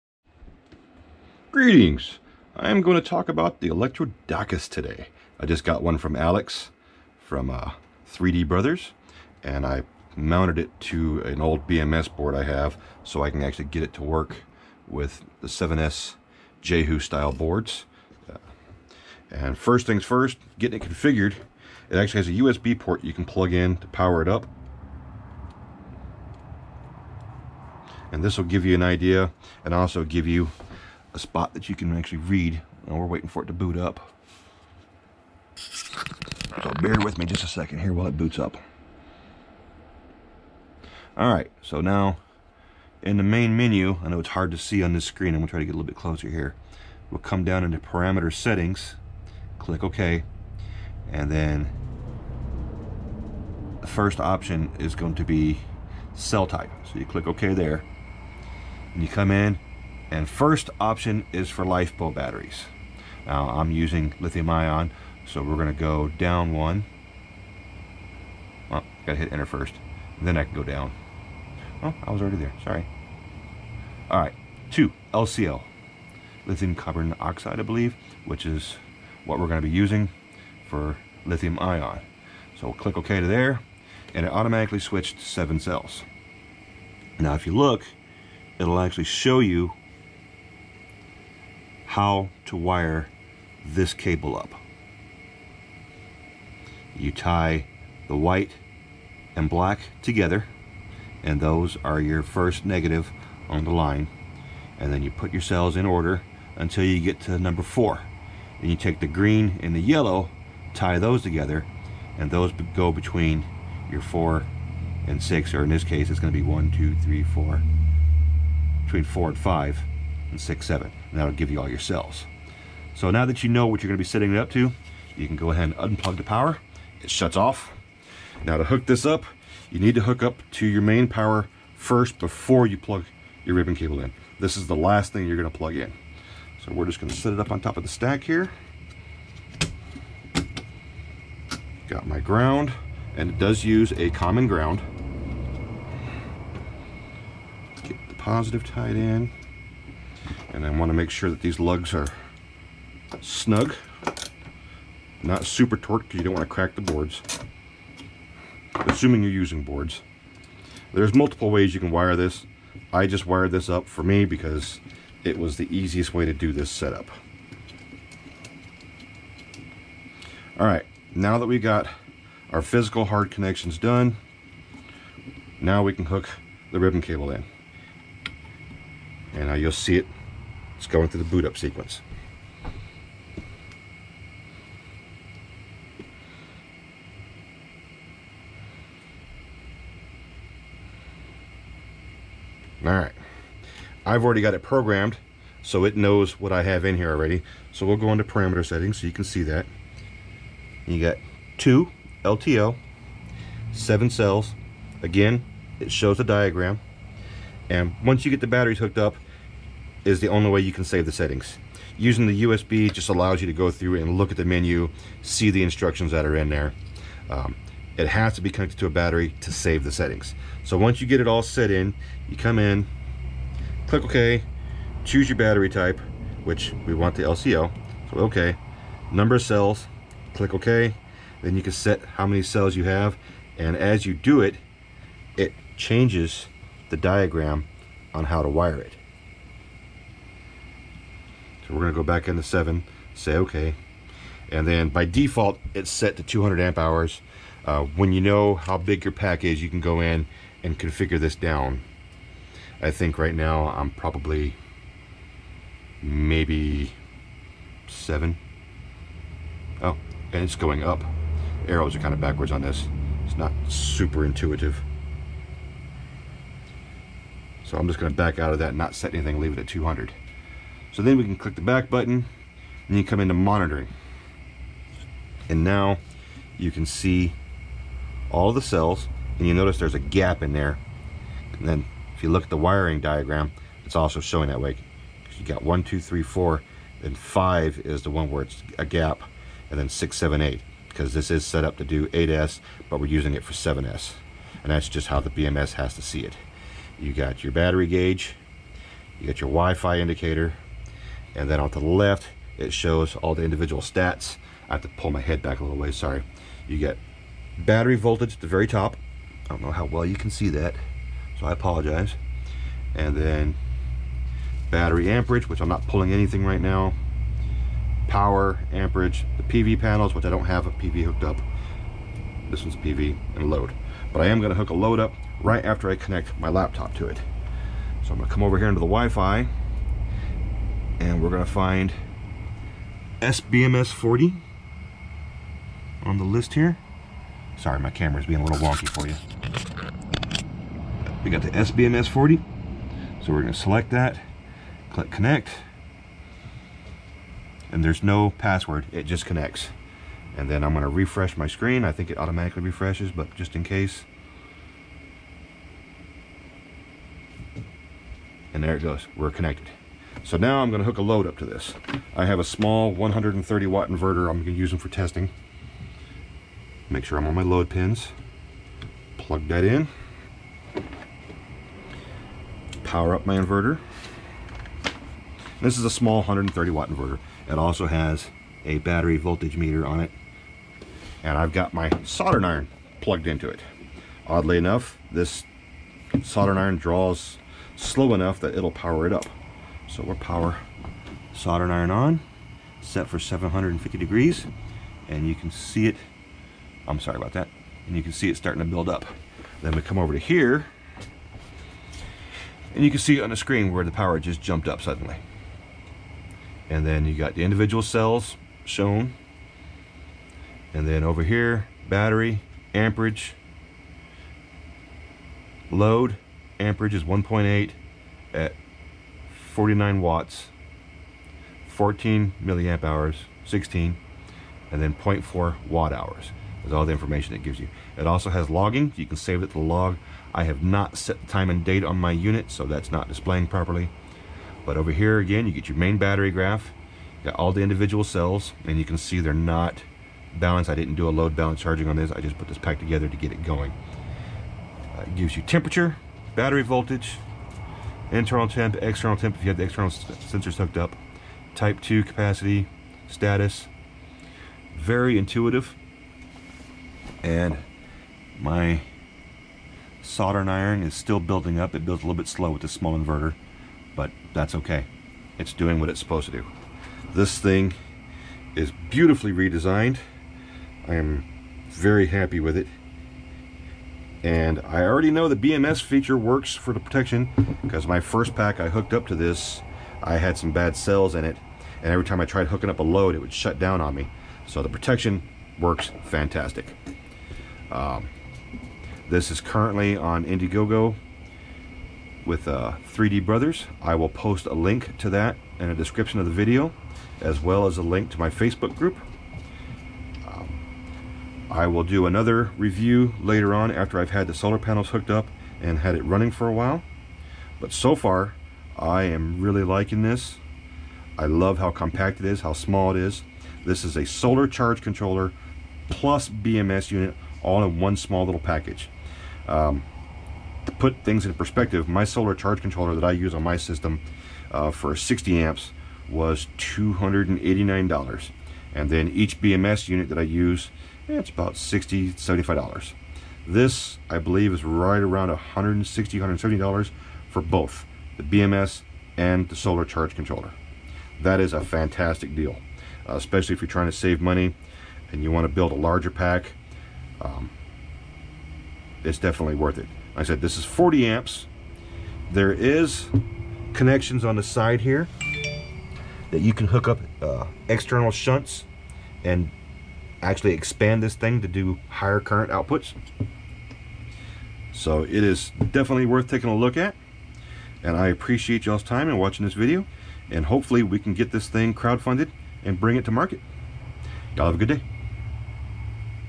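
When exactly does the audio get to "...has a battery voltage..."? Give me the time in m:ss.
6:17.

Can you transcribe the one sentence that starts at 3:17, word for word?
So we'll go into parameter settings so you can see that.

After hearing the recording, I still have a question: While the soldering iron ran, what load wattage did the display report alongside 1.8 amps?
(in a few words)
49.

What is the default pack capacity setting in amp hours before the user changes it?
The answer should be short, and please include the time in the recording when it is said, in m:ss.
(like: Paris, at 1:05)
200, at 4:06.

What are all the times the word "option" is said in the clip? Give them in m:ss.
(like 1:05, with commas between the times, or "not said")
0:54, 1:00.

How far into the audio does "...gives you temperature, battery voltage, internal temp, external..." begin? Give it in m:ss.
7:25.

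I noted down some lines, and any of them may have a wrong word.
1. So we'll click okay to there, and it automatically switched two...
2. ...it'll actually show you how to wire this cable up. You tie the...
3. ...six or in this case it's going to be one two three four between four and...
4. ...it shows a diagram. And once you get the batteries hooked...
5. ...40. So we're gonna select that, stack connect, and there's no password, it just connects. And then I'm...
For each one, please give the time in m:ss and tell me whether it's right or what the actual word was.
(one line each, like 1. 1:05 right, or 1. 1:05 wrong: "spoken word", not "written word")
1. 1:22 wrong: "seven", not "two"
2. 1:28 right
3. 1:55 right
4. 3:25 right
5. 5:42 wrong: "click", not "stack".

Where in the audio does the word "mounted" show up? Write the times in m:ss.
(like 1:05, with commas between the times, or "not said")
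0:10.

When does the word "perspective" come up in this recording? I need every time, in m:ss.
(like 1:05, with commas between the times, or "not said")
8:41.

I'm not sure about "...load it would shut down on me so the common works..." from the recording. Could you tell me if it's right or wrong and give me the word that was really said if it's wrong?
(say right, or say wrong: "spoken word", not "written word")
wrong: "protection", not "common".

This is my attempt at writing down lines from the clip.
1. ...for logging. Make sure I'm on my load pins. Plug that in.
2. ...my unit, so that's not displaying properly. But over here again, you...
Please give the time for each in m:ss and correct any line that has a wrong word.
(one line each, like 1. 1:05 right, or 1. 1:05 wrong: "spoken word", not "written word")
1. 6:04 wrong: "testing", not "logging"
2. 7:11 right.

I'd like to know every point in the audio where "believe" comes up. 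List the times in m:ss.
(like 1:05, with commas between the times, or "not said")
1:17, 8:54.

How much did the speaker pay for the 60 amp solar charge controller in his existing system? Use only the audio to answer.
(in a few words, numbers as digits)
$289.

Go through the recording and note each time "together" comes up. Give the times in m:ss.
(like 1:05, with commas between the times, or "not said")
1:40, 1:51, 7:22.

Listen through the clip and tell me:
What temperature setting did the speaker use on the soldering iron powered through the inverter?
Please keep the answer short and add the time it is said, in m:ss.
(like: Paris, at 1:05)
750 degrees, at 6:33.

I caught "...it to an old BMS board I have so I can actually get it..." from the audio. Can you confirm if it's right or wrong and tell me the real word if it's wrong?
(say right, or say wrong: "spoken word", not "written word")
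right.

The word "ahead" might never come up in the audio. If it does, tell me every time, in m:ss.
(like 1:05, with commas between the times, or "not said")
2:05.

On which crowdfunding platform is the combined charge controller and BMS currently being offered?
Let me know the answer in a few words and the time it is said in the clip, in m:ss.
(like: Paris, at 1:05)
Indiegogo, at 8:10.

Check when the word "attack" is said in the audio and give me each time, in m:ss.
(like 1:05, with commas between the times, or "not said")
not said.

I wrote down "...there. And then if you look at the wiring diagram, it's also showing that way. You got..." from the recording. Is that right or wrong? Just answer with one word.
right.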